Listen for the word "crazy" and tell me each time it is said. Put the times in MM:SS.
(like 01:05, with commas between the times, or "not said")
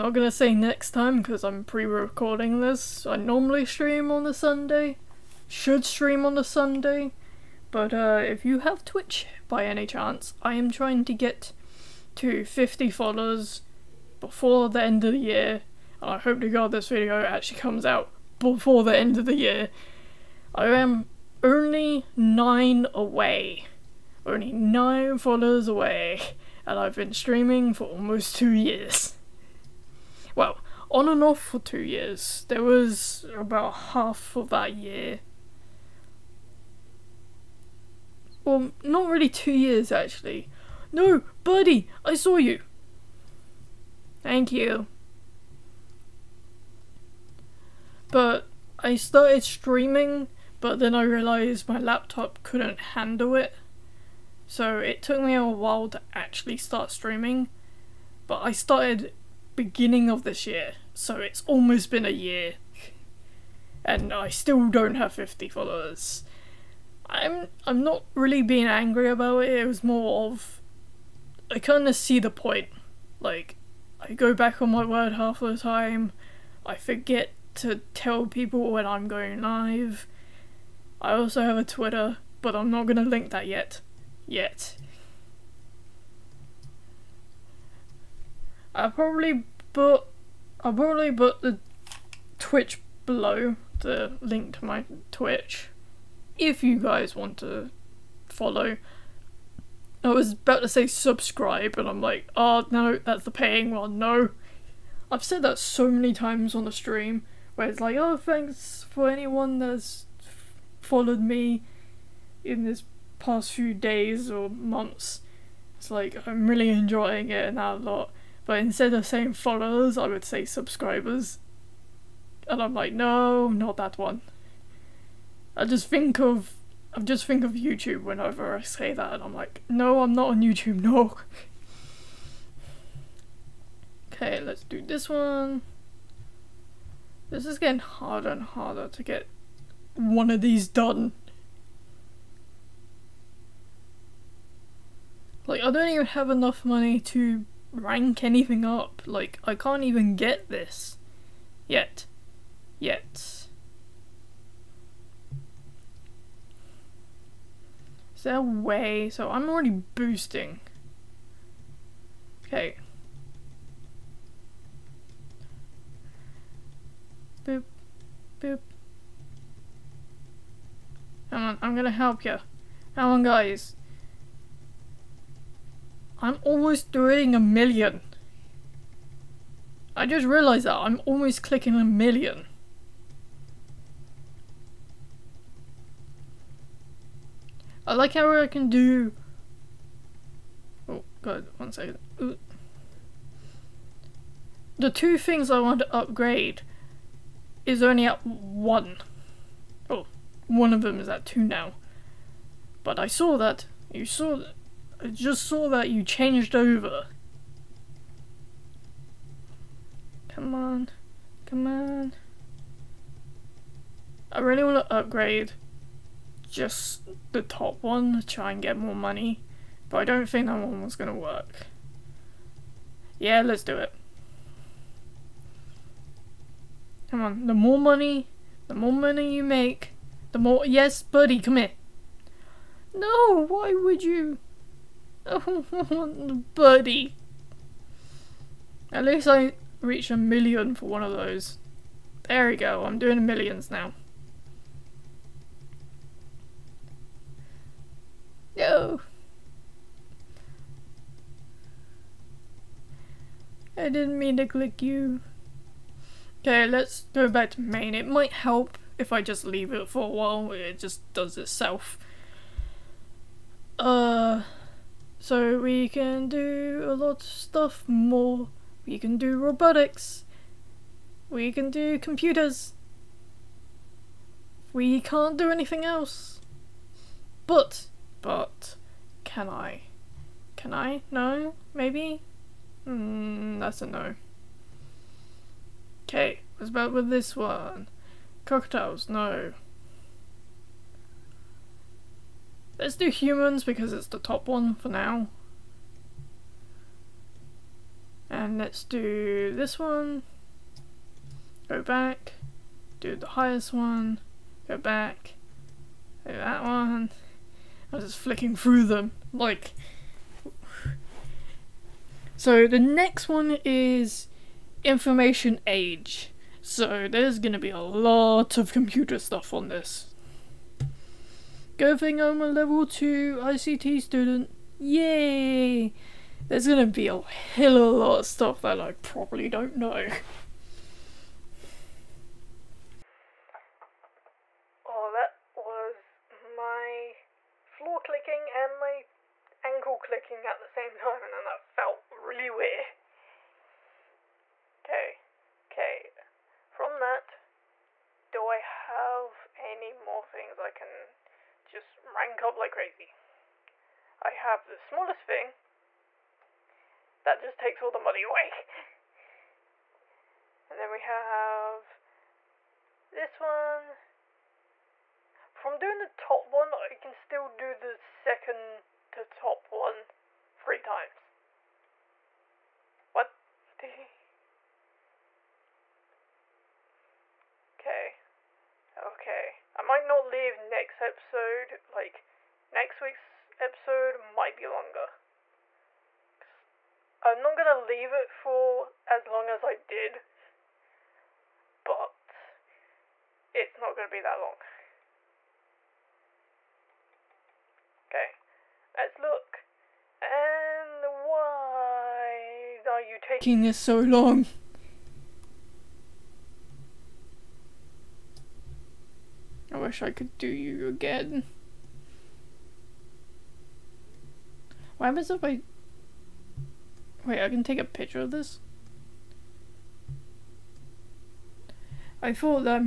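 05:52.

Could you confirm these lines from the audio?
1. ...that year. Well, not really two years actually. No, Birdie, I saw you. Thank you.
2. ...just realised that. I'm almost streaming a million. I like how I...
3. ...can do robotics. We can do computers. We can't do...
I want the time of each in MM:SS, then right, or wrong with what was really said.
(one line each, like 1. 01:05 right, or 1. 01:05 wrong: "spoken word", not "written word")
1. 00:34 right
2. 03:00 wrong: "clicking", not "streaming"
3. 04:28 right.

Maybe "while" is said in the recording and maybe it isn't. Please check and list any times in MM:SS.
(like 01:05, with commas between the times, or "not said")
00:55, 04:20.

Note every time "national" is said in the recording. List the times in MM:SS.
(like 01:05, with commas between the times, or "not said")
not said.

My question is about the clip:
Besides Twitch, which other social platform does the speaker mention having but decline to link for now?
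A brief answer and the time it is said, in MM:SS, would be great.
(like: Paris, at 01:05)
Twitter, at 01:21.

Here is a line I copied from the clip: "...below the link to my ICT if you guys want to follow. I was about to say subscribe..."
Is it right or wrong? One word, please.
wrong.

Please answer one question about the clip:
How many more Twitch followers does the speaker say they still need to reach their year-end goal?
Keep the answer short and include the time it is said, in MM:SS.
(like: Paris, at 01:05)
9, at 00:24.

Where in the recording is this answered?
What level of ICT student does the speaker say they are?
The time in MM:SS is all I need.
05:22.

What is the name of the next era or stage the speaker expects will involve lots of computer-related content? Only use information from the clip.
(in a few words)
Information age.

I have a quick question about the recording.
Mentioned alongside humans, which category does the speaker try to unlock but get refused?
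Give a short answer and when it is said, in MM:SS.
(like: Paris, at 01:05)
Cocktails, at 04:48.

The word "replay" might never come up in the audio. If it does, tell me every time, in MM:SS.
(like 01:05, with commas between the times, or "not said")
not said.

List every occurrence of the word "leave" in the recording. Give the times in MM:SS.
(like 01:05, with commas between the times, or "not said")
04:19, 06:20, 06:27.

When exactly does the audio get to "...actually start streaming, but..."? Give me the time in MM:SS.
00:56.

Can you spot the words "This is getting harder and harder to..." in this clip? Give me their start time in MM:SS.
02:17.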